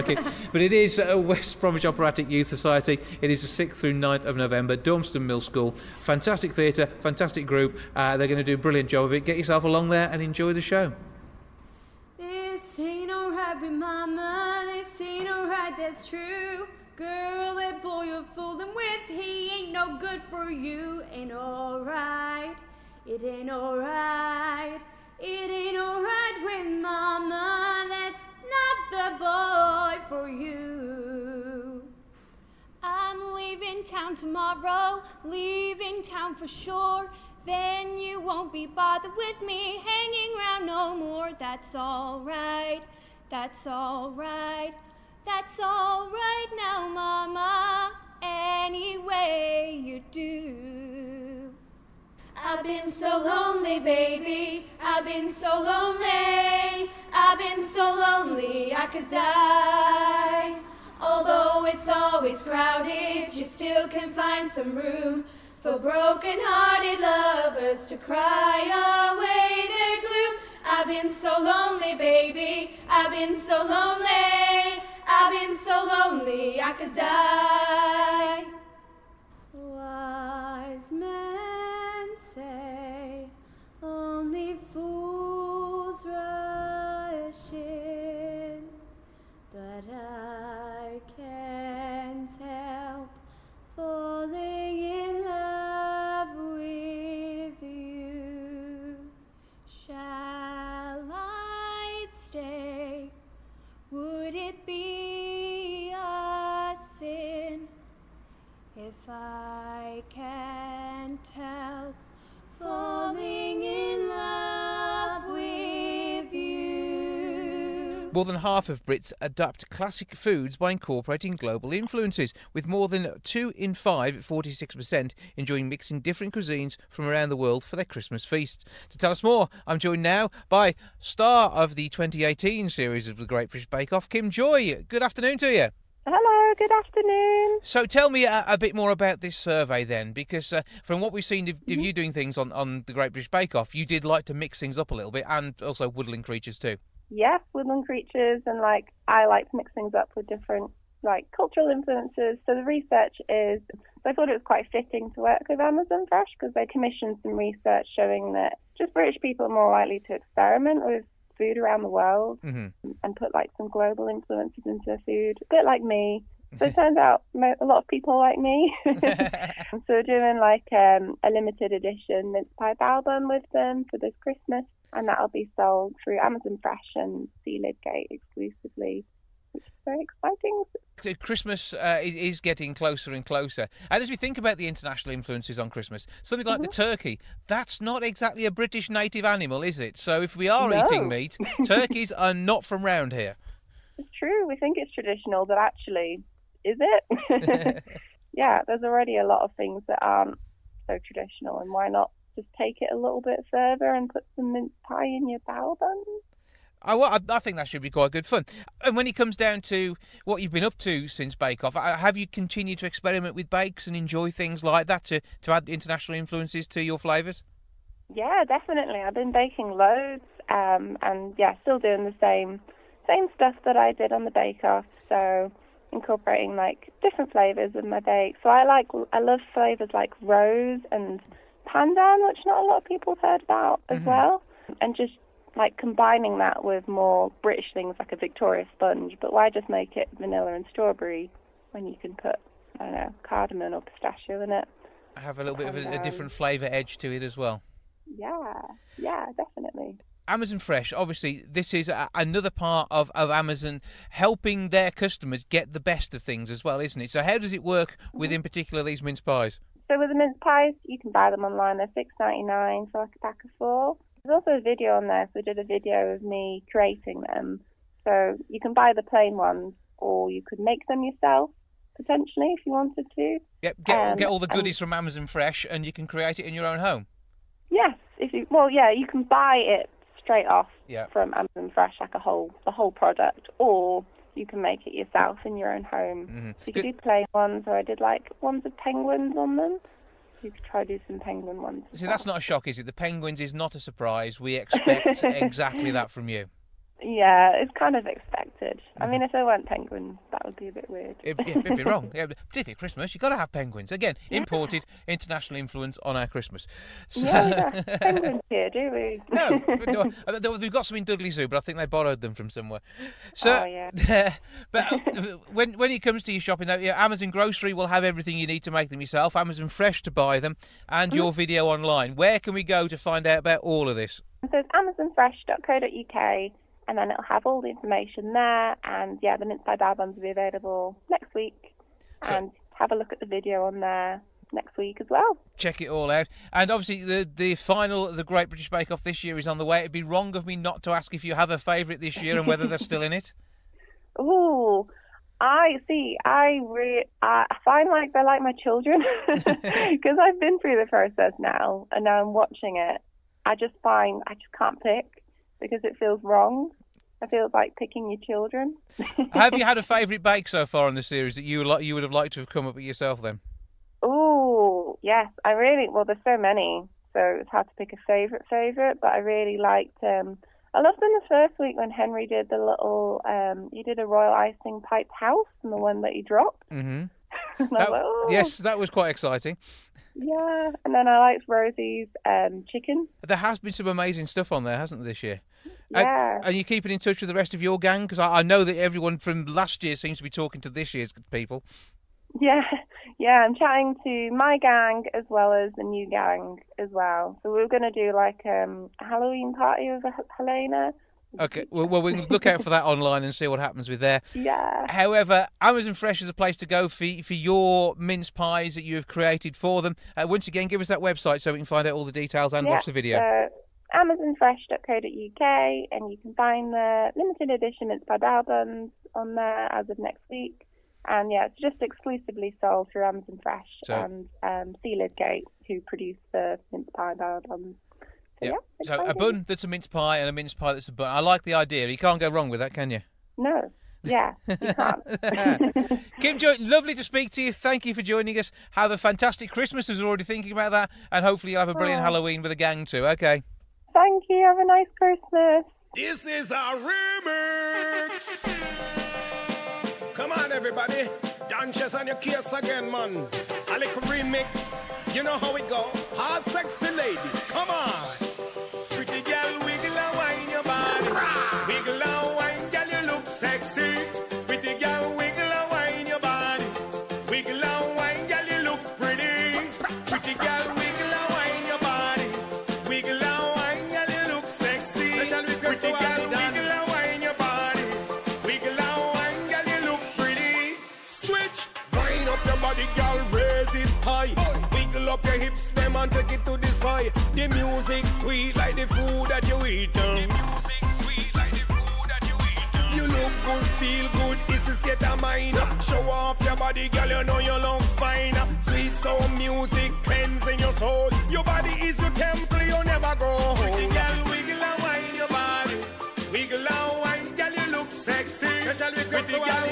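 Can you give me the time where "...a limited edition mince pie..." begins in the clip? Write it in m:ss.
2:51.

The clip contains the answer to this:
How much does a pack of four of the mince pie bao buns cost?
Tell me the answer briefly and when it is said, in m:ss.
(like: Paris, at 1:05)
£6.99, at 4:21.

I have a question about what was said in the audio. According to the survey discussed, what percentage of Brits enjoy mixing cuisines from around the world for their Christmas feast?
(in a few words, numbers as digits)
46%.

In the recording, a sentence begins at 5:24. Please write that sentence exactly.
So it's amazonfresh.co.uk and then it'll have all the information there.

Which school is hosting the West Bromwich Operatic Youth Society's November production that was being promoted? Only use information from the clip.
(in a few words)
Dormston Mill School.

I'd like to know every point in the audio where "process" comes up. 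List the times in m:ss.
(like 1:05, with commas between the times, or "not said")
5:50.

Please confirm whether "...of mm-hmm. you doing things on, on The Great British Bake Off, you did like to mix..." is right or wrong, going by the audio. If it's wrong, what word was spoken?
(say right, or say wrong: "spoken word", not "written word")
right.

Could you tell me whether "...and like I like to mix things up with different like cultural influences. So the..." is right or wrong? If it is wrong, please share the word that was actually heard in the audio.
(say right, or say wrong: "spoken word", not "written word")
right.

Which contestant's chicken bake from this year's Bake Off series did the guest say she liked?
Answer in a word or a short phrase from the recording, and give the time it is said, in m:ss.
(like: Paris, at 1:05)
Rosie, at 6:21.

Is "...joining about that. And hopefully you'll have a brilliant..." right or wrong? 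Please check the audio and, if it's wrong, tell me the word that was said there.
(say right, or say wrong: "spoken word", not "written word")
wrong: "thinking", not "joining".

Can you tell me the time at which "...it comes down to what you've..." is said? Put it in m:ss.
3:29.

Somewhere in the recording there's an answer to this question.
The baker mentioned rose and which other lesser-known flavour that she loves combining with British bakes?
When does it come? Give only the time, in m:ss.
3:51.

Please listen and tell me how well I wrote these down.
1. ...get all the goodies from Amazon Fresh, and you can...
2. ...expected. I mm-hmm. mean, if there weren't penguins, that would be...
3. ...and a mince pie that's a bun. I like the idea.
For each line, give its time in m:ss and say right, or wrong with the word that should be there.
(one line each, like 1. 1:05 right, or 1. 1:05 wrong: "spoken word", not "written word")
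1. 4:34 right
2. 4:58 right
3. 7:10 right.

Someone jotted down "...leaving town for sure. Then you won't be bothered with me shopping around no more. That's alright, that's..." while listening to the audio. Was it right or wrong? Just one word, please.
wrong.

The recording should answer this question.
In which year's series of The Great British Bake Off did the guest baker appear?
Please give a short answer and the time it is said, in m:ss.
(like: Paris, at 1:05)
2018, at 2:11.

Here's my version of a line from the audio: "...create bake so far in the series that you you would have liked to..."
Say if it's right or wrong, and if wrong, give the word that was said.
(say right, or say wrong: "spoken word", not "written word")
wrong: "favourite", not "create".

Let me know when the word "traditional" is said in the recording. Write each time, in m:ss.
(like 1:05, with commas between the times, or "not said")
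3:14, 3:21.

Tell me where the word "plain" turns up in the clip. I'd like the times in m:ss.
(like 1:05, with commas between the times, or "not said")
4:29, 4:46.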